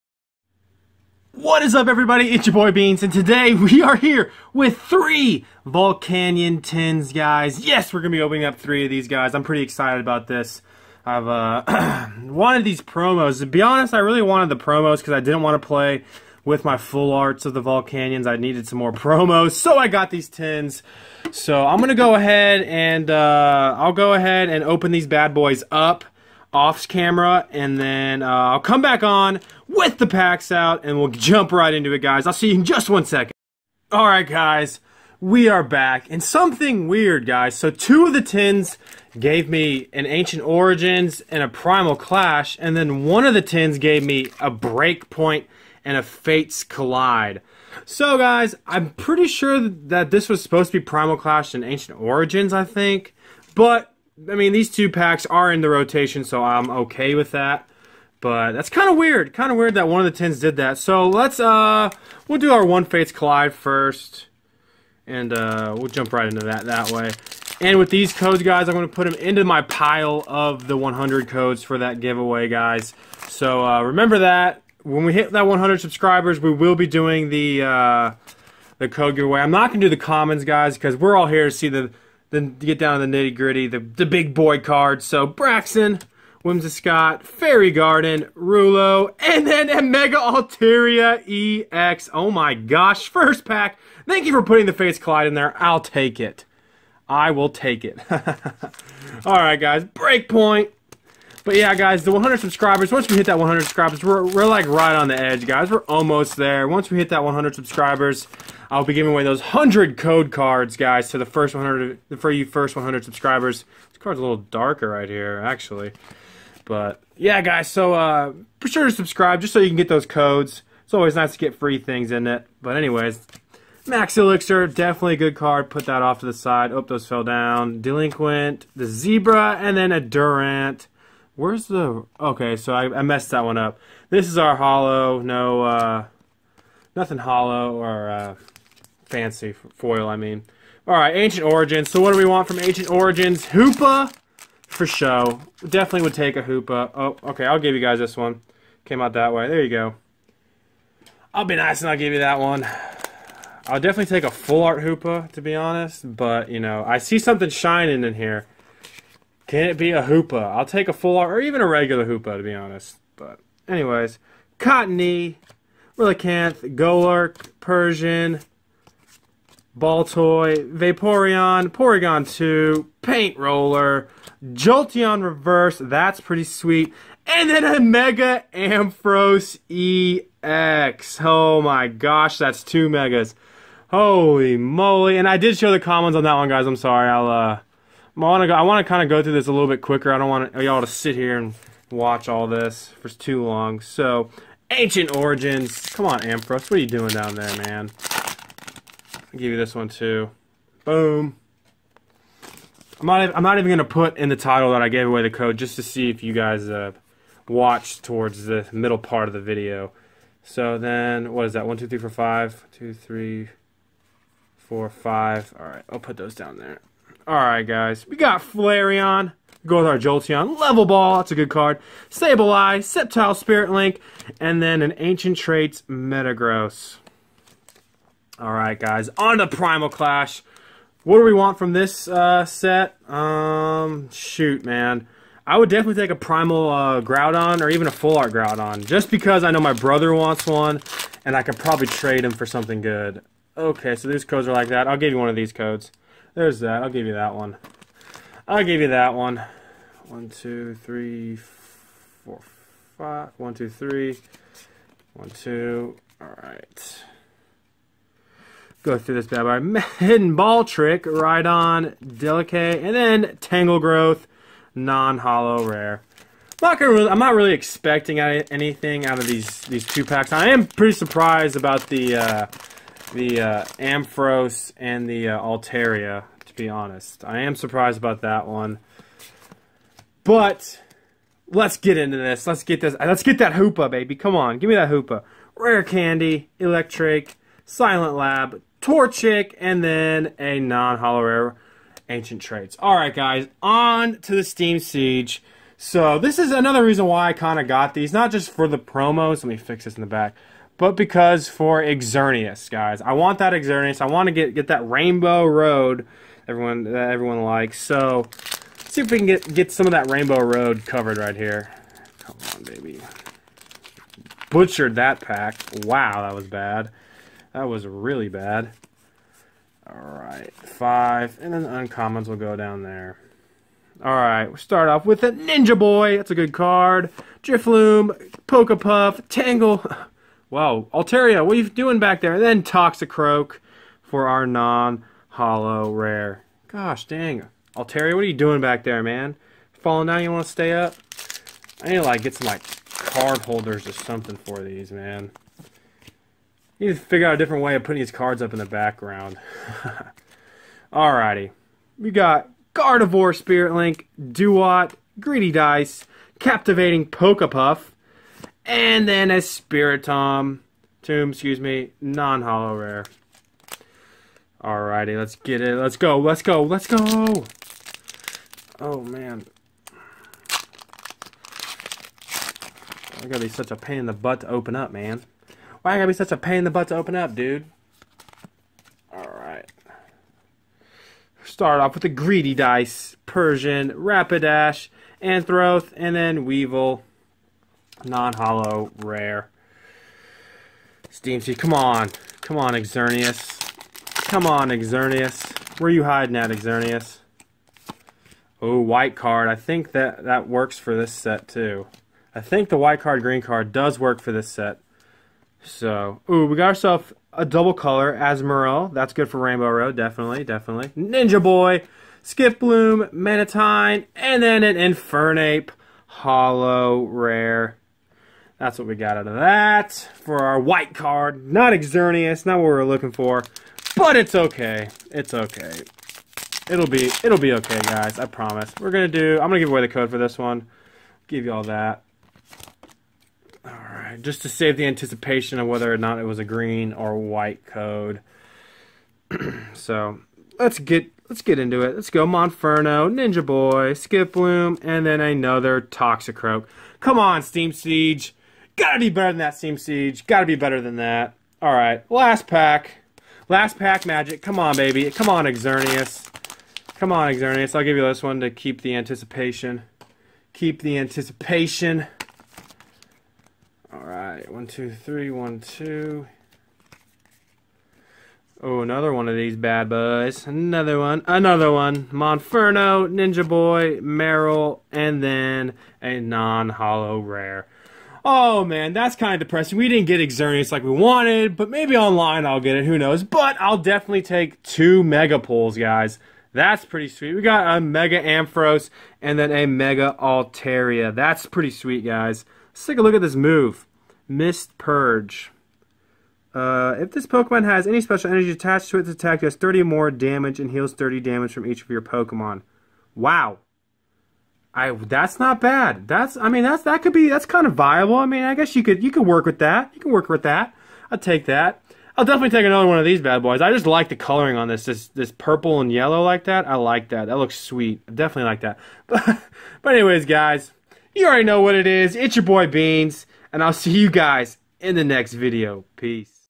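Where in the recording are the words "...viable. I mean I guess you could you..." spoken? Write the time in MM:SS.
08:27.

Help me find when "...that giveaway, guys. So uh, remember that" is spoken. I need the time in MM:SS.
01:11.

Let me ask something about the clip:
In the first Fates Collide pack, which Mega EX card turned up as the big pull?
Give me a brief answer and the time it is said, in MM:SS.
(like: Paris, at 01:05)
Mega Altaria EX, at 01:29.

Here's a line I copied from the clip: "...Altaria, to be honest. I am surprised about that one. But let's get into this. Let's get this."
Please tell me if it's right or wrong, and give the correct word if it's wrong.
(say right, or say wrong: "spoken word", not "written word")
right.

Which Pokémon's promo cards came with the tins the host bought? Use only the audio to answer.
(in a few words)
Volcanion.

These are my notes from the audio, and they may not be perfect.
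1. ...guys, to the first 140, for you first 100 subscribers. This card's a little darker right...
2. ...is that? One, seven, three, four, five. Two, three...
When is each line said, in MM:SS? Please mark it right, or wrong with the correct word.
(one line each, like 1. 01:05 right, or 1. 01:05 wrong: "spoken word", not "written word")
1. 01:50 wrong: "100", not "140"
2. 03:31 wrong: "two", not "seven".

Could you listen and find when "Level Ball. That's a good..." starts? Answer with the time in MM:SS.
03:40.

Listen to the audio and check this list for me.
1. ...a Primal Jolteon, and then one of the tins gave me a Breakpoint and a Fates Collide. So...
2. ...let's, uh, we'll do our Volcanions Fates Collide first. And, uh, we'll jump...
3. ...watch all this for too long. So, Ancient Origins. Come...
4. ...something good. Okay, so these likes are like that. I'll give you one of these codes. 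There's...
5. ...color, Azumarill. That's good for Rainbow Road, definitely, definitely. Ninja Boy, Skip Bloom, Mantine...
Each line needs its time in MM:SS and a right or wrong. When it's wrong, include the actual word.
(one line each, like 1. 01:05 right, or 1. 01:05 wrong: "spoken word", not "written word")
1. 00:41 wrong: "Clash", not "Jolteon"
2. 01:01 wrong: "One", not "Volcanions"
3. 03:11 right
4. 04:02 wrong: "codes", not "likes"
5. 06:47 right.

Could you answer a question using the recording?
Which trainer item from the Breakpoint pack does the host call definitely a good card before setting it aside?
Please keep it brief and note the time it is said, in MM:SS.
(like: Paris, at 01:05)
Max Elixir, at 02:03.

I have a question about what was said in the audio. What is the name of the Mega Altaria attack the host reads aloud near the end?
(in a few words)
Mist Purge.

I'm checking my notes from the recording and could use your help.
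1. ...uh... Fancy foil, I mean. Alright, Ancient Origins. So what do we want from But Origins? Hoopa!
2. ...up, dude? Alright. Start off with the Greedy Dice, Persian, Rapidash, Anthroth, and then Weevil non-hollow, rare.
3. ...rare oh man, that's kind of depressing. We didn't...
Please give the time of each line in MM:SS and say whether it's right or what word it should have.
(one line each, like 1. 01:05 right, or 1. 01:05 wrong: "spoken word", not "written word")
1. 02:18 wrong: "Ancient", not "But"
2. 06:17 right
3. 07:57 right.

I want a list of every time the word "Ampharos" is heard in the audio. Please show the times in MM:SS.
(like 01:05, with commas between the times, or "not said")
02:58, 03:16, 04:33, 08:08.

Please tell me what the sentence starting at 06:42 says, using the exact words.
I think the white card, green card does work for this set.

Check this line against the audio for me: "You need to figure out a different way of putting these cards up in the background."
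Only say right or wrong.
right.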